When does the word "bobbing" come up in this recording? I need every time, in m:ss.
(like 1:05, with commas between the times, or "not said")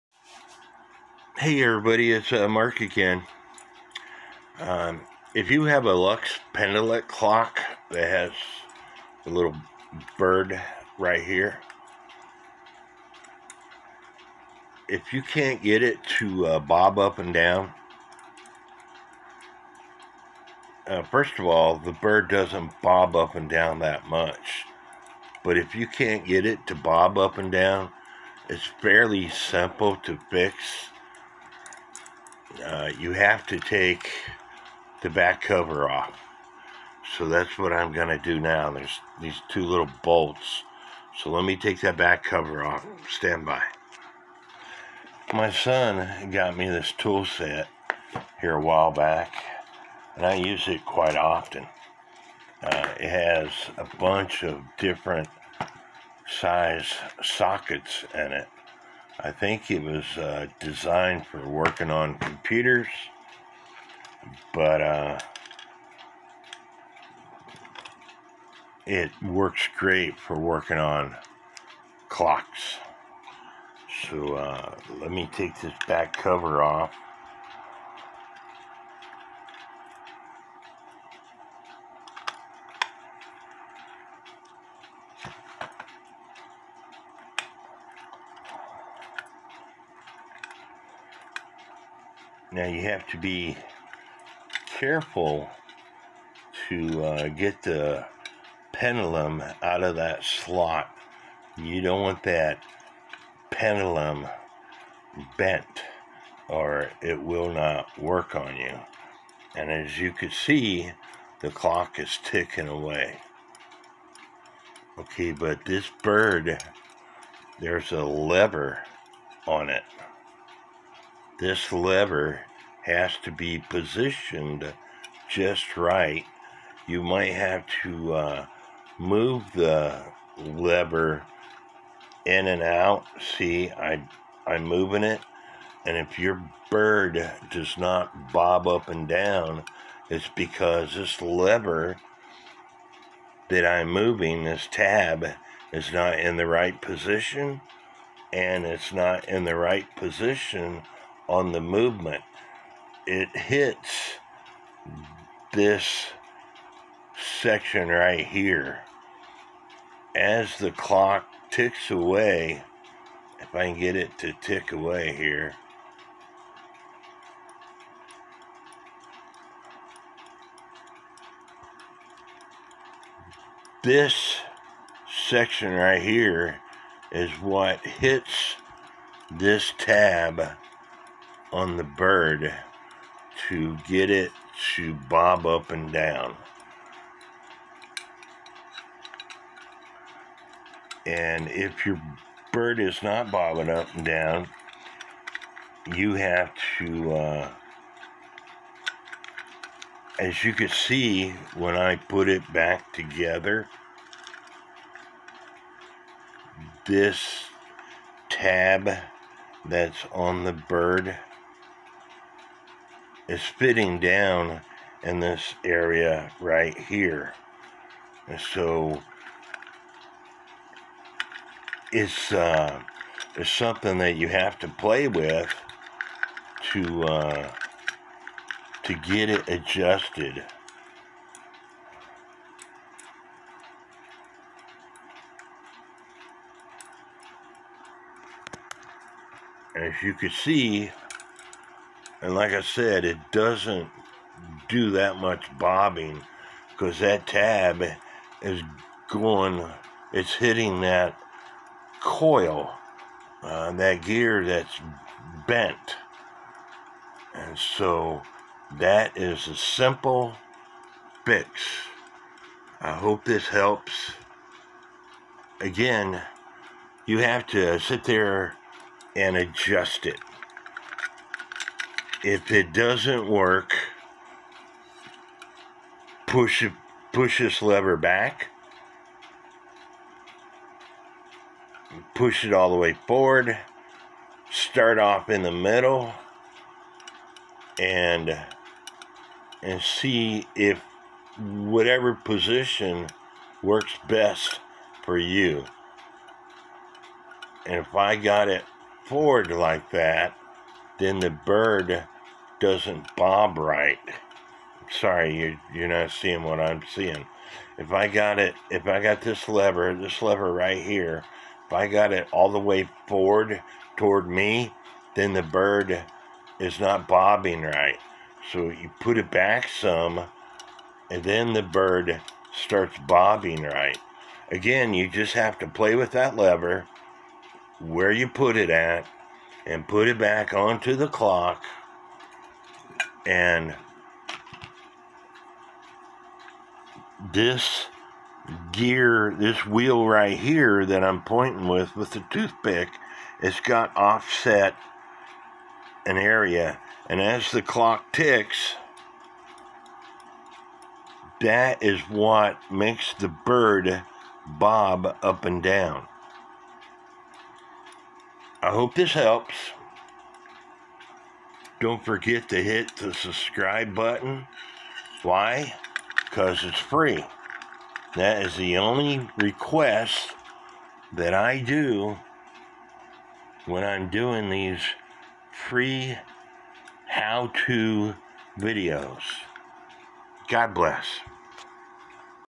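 3:13, 4:05, 5:17, 5:23.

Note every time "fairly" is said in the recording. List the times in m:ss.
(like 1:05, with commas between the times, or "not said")
0:28.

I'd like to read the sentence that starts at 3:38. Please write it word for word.
And so it's, uh, it's something that you have to play with to, uh, to get it adjusted.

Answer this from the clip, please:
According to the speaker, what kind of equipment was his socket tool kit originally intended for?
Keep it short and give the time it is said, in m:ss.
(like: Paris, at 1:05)
Computers, at 1:02.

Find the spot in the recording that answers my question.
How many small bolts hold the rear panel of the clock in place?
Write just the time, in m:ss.
0:39.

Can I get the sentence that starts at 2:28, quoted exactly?
And it's not in the right position on the movement, it hits this section right here.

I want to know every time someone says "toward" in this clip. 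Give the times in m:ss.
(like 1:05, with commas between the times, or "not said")
5:13.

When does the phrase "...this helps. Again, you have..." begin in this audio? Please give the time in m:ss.
4:23.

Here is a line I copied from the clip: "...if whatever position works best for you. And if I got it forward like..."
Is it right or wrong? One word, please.
right.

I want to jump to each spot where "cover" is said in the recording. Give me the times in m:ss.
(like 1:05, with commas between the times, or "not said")
0:35, 0:42, 1:16.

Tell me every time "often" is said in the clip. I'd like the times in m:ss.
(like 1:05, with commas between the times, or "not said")
0:51.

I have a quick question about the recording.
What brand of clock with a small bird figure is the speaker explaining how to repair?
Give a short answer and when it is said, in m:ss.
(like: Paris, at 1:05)
Lux Pendulete, at 0:05.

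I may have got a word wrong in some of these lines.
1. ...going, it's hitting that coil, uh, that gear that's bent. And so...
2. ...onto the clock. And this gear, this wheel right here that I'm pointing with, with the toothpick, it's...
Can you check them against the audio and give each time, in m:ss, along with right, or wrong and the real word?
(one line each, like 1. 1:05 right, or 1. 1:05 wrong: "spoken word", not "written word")
1. 4:09 right
2. 5:30 right.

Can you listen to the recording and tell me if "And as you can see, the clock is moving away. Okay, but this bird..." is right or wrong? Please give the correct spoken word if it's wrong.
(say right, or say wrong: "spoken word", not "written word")
wrong: "ticking", not "moving".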